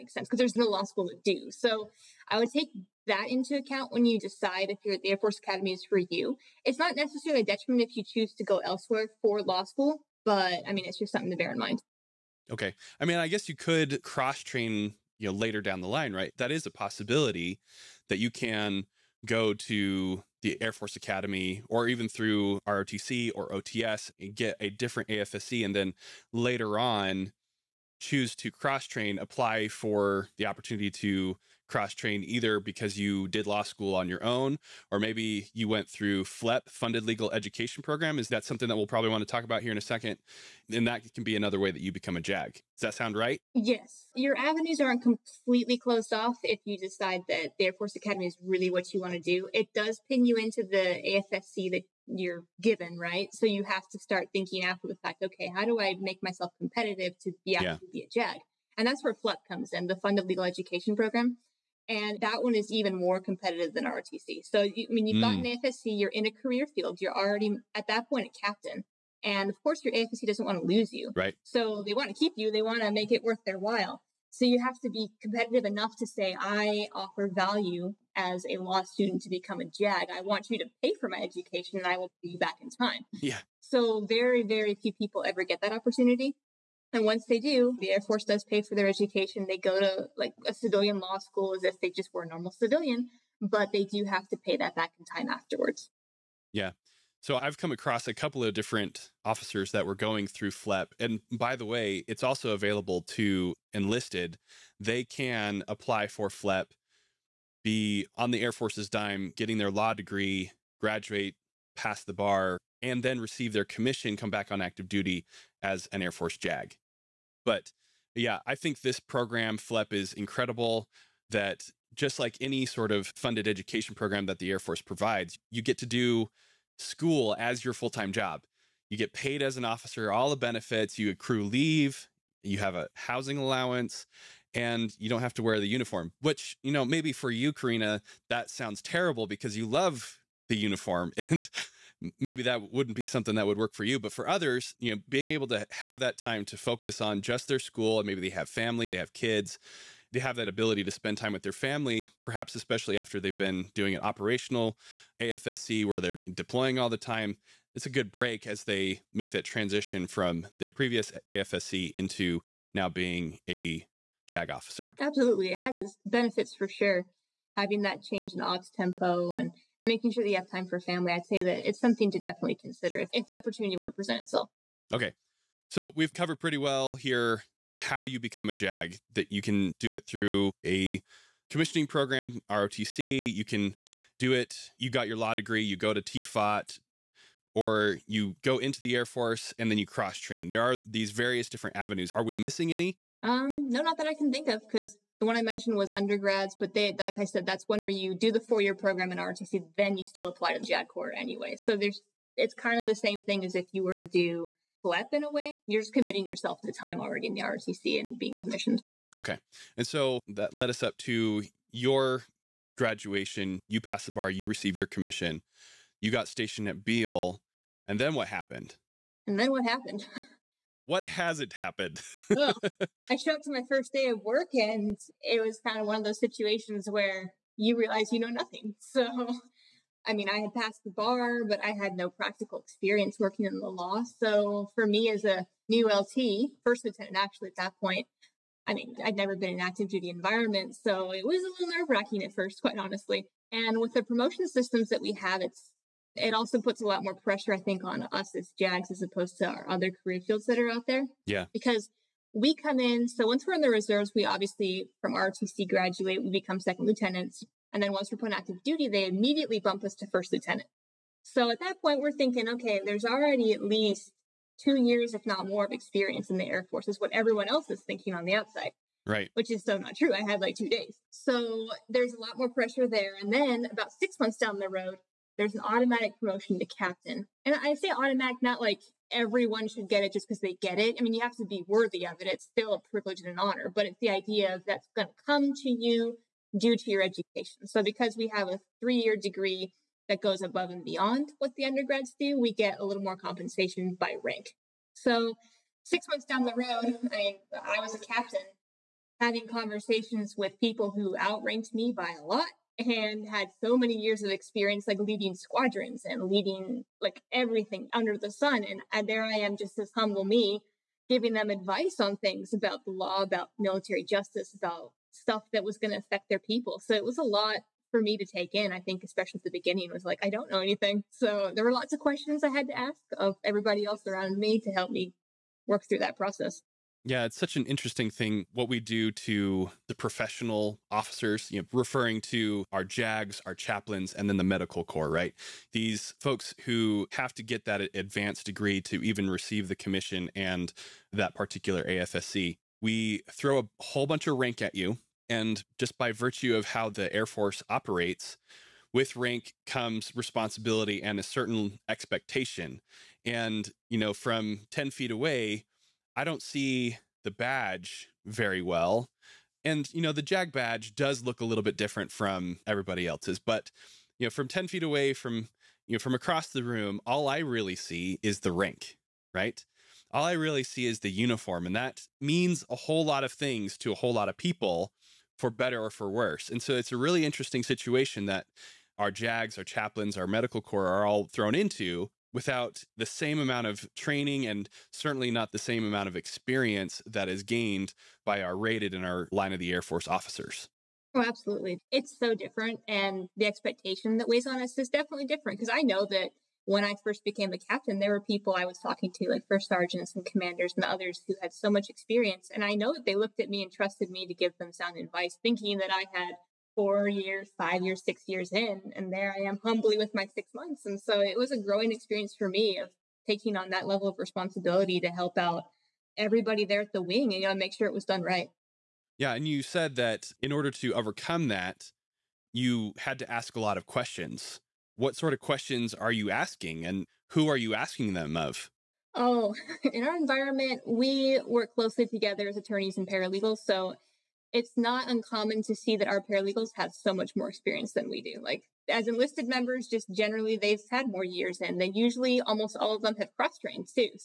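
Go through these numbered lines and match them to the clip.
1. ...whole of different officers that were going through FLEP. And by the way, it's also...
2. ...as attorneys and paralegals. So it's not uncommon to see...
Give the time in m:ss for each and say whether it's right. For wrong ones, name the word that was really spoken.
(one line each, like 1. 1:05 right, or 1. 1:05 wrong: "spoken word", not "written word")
1. 1:38 wrong: "couple", not "whole"
2. 7:12 right.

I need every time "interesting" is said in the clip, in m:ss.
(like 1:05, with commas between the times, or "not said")
5:27, 6:17.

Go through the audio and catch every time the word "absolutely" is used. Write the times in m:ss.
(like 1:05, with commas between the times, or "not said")
2:44, 6:31.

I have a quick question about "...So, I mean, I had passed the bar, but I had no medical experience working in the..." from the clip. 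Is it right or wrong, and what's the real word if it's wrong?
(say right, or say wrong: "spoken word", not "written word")
wrong: "practical", not "medical".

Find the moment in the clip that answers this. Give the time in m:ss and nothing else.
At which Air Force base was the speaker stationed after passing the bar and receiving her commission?
3:36.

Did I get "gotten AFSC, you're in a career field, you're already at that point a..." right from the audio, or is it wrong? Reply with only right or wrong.
right.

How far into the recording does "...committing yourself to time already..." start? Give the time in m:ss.
3:25.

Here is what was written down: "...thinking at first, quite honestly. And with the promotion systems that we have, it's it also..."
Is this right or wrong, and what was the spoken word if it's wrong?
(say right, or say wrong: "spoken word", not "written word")
wrong: "wracking", not "thinking".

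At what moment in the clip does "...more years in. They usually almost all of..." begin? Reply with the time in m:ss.
7:21.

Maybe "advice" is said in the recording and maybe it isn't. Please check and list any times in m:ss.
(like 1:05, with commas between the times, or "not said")
5:11, 6:44.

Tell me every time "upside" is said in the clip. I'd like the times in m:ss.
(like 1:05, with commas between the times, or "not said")
not said.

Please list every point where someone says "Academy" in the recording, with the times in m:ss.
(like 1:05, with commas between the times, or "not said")
0:05, 0:20, 0:47.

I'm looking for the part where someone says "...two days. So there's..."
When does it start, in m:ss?
4:30.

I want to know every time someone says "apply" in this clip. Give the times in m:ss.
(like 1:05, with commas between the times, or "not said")
0:29, 1:45, 3:20.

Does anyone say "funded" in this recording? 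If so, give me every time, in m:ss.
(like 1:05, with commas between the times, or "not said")
0:36, 0:59, 2:03.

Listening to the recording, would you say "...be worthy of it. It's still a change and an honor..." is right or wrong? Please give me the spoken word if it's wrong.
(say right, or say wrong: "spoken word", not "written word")
wrong: "privilege", not "change".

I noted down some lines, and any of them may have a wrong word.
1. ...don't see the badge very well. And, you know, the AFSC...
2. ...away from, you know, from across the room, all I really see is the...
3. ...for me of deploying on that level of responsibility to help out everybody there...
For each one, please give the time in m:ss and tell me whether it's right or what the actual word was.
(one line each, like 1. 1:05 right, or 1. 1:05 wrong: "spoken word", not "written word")
1. 5:56 wrong: "JAG", not "AFSC"
2. 6:04 right
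3. 6:52 wrong: "taking", not "deploying".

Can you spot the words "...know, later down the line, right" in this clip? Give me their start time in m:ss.
0:15.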